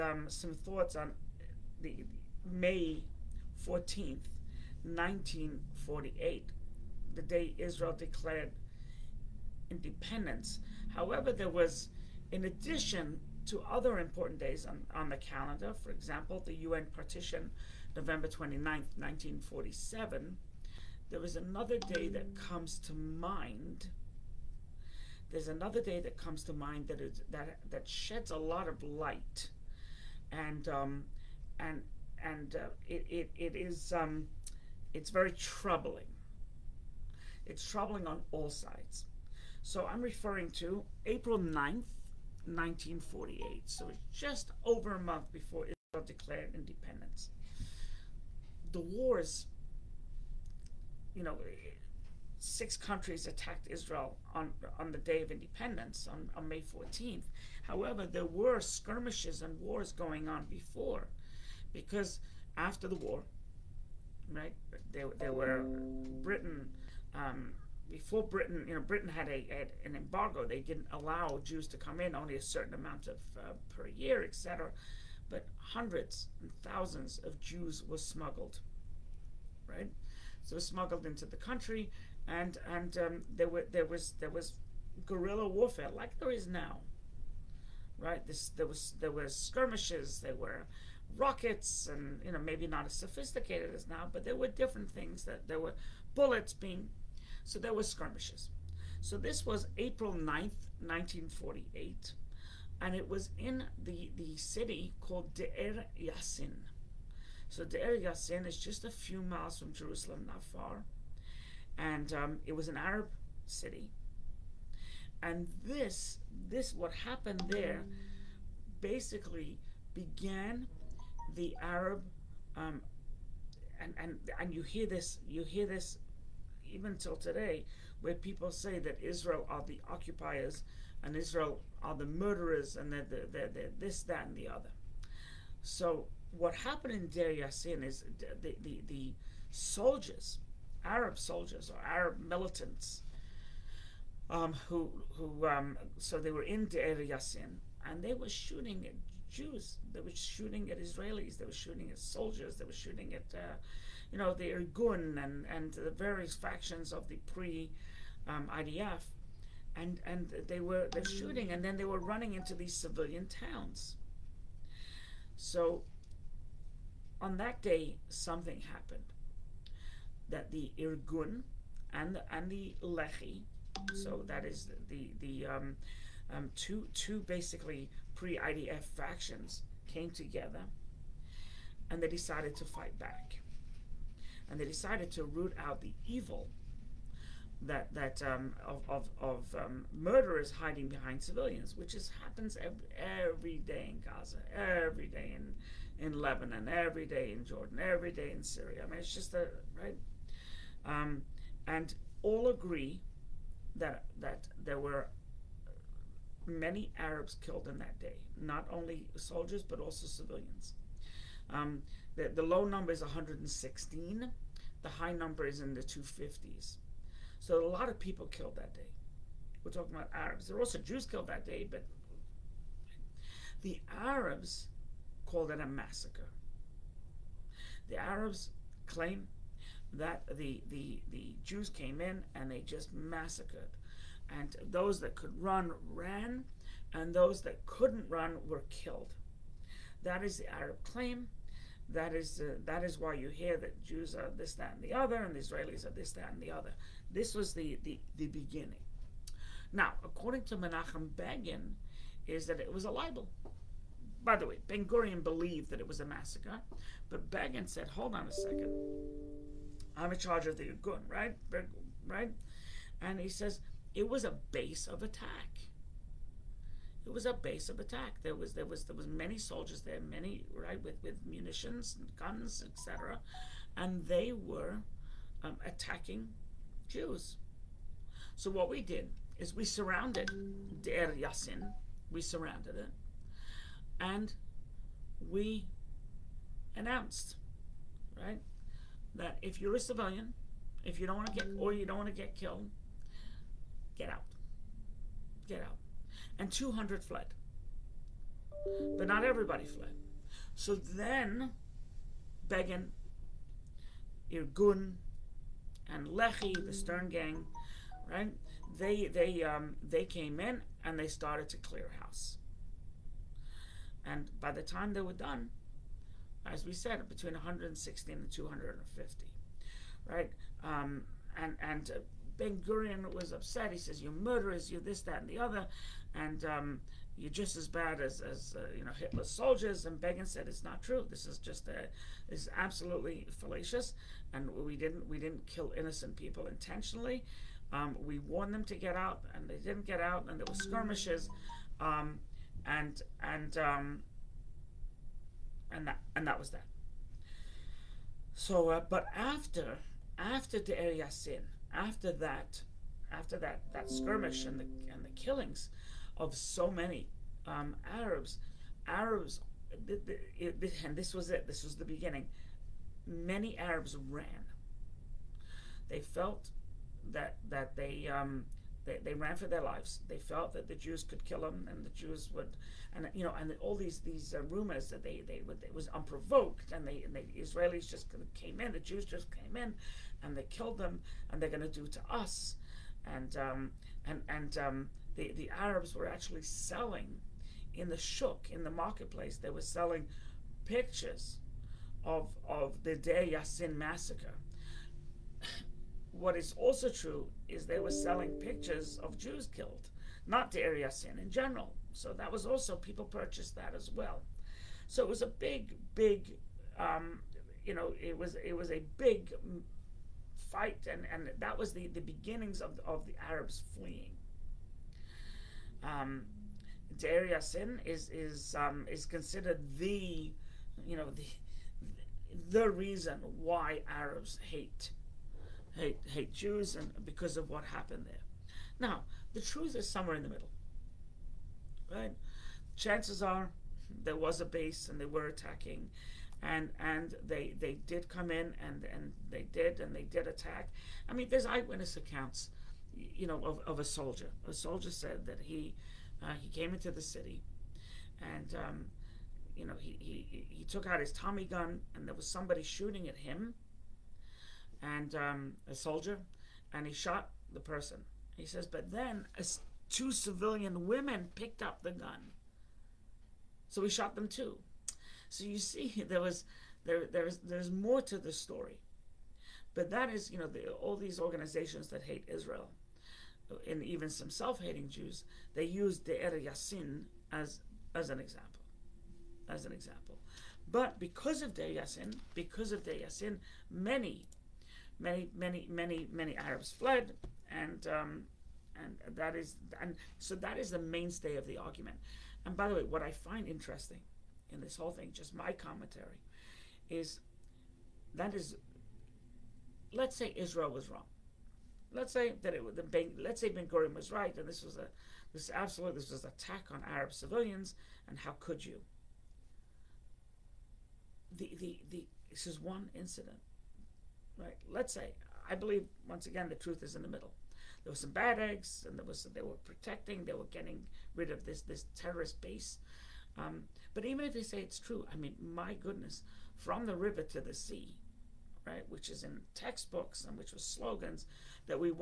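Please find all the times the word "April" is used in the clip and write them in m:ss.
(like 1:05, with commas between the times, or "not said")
0:41, 1:39.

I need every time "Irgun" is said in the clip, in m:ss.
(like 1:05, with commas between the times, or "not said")
2:34, 2:50, 4:20, 5:04.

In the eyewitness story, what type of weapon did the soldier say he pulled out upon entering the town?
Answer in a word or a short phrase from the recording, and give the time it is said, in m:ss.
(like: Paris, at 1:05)
Tommy gun, at 7:31.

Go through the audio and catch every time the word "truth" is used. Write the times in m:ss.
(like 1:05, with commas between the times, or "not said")
7:09, 8:36.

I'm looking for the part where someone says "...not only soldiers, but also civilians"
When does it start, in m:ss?
3:28.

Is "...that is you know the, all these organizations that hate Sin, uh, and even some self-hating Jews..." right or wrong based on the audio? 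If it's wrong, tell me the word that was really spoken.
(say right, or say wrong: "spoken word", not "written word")
wrong: "Israel", not "Sin".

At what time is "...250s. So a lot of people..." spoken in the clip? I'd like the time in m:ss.
3:35.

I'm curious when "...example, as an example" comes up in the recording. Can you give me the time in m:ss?
7:58.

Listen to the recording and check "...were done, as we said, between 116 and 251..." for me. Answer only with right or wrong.
wrong.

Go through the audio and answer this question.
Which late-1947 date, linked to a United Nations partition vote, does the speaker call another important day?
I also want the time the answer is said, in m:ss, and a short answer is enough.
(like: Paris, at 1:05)
November 29th, 1947, at 0:17.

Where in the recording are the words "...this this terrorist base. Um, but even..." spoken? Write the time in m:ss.
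8:41.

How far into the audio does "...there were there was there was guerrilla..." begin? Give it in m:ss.
1:23.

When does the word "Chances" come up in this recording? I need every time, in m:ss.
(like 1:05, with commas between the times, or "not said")
7:12.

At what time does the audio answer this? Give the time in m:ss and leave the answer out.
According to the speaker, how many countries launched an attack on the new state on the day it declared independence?
0:52.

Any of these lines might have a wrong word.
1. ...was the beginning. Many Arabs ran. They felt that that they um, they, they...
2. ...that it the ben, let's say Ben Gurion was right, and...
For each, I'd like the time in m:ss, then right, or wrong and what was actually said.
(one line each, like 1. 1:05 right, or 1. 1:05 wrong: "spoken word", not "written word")
1. 6:01 right
2. 8:22 right.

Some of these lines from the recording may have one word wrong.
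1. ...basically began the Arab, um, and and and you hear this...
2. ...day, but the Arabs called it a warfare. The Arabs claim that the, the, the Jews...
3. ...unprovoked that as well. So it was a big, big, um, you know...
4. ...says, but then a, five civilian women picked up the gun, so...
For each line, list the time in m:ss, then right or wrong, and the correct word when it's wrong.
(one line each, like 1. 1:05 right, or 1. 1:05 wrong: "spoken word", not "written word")
1. 1:58 right
2. 3:41 wrong: "massacre", not "warfare"
3. 6:43 wrong: "purchased", not "unprovoked"
4. 7:38 wrong: "two", not "five".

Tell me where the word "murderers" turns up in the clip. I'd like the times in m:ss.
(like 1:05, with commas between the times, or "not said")
2:12, 3:09, 5:24.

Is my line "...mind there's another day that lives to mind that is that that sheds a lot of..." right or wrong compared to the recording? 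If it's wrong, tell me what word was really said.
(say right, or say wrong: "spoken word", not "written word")
wrong: "comes", not "lives".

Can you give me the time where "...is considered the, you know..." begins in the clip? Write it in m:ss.
6:58.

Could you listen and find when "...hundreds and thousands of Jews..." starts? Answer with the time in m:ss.
1:15.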